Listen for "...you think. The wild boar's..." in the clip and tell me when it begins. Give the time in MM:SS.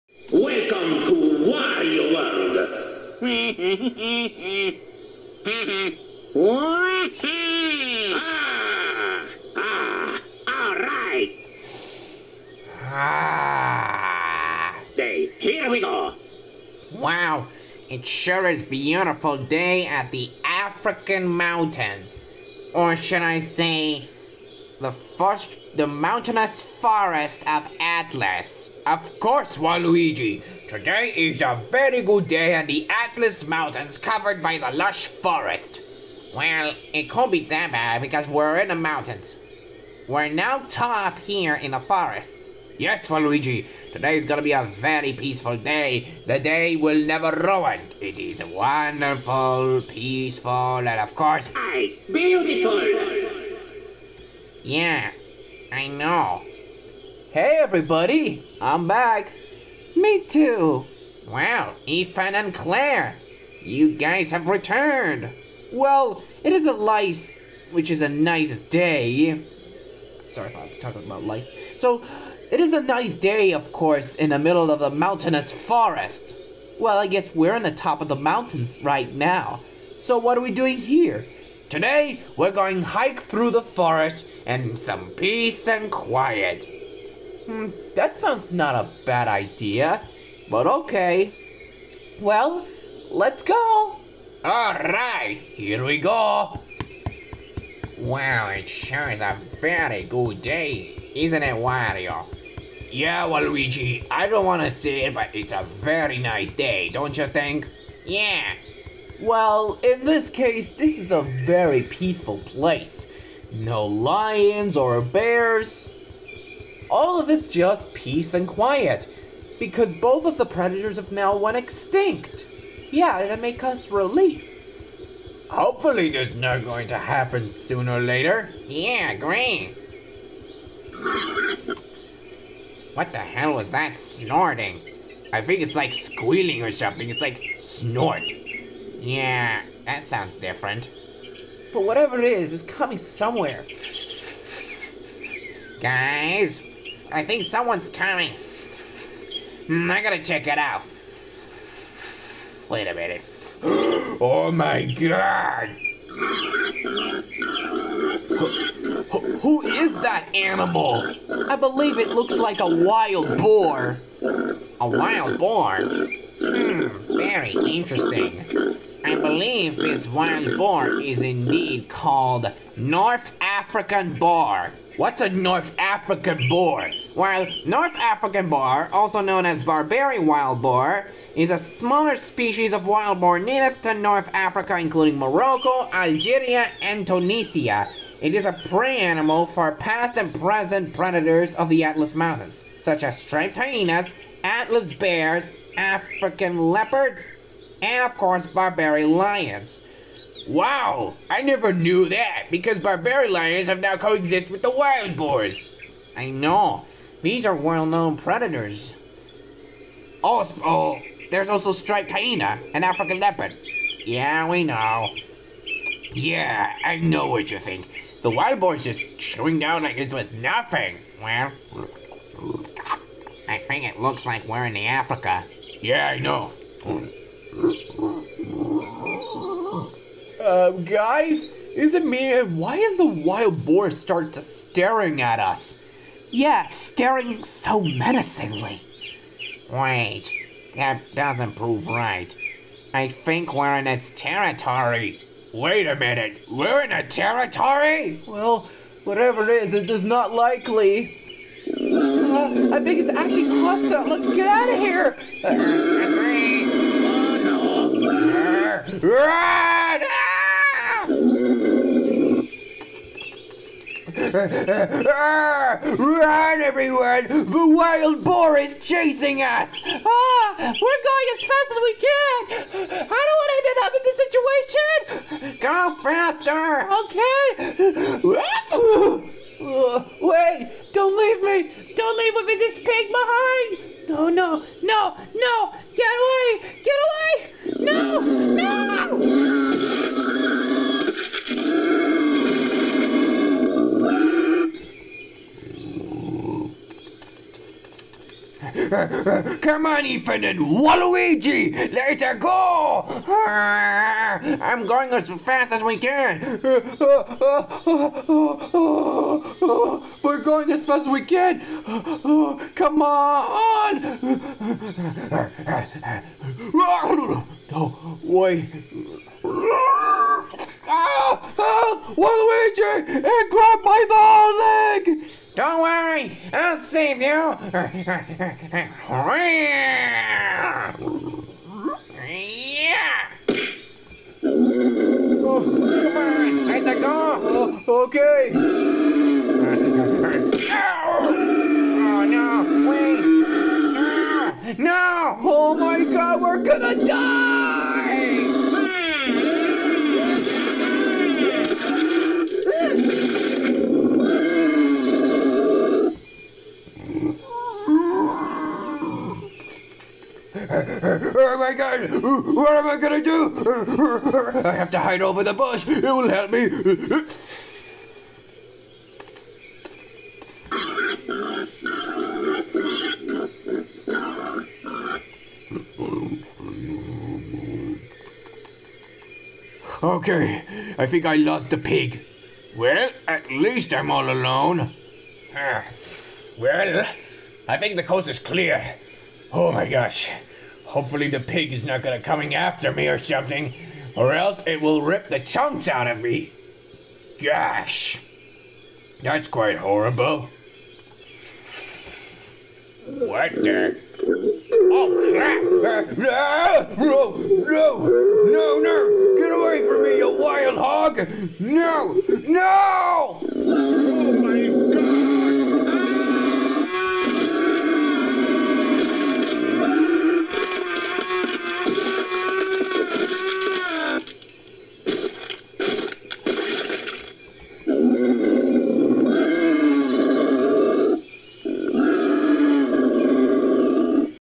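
03:37.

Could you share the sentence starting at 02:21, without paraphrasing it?
But whatever it is, it's coming somewhere.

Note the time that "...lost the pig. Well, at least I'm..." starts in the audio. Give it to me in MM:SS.
06:21.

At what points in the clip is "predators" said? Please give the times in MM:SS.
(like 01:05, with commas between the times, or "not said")
02:00, 03:10, 03:28.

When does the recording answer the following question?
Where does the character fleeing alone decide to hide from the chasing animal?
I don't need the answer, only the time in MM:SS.
06:05.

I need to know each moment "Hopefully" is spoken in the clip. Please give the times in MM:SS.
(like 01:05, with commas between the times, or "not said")
02:05, 06:30.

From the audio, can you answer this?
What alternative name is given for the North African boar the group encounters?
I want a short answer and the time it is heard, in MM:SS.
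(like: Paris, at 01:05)
barbary wild boar, at 02:59.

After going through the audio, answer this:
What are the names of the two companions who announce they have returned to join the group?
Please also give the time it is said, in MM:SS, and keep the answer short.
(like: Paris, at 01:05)
Ethan and Clair, at 01:01.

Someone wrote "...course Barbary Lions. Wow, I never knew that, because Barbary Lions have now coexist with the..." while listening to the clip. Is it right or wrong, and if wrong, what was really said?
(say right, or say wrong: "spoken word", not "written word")
right.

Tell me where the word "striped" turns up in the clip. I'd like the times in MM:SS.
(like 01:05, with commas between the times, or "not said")
03:13, 03:31.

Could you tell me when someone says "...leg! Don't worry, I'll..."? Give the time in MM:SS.
05:25.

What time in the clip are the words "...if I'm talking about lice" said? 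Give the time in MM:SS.
01:10.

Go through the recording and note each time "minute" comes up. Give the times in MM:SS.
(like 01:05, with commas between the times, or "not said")
02:32, 04:05.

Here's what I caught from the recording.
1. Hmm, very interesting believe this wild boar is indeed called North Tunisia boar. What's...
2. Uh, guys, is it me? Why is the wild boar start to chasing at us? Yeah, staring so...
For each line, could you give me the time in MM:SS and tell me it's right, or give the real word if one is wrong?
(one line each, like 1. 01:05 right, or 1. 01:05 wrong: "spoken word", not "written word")
1. 02:45 wrong: "African", not "Tunisia"
2. 03:50 wrong: "staring", not "chasing".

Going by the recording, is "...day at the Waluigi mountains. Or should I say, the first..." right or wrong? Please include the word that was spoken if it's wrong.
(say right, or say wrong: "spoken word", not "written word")
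wrong: "African", not "Waluigi".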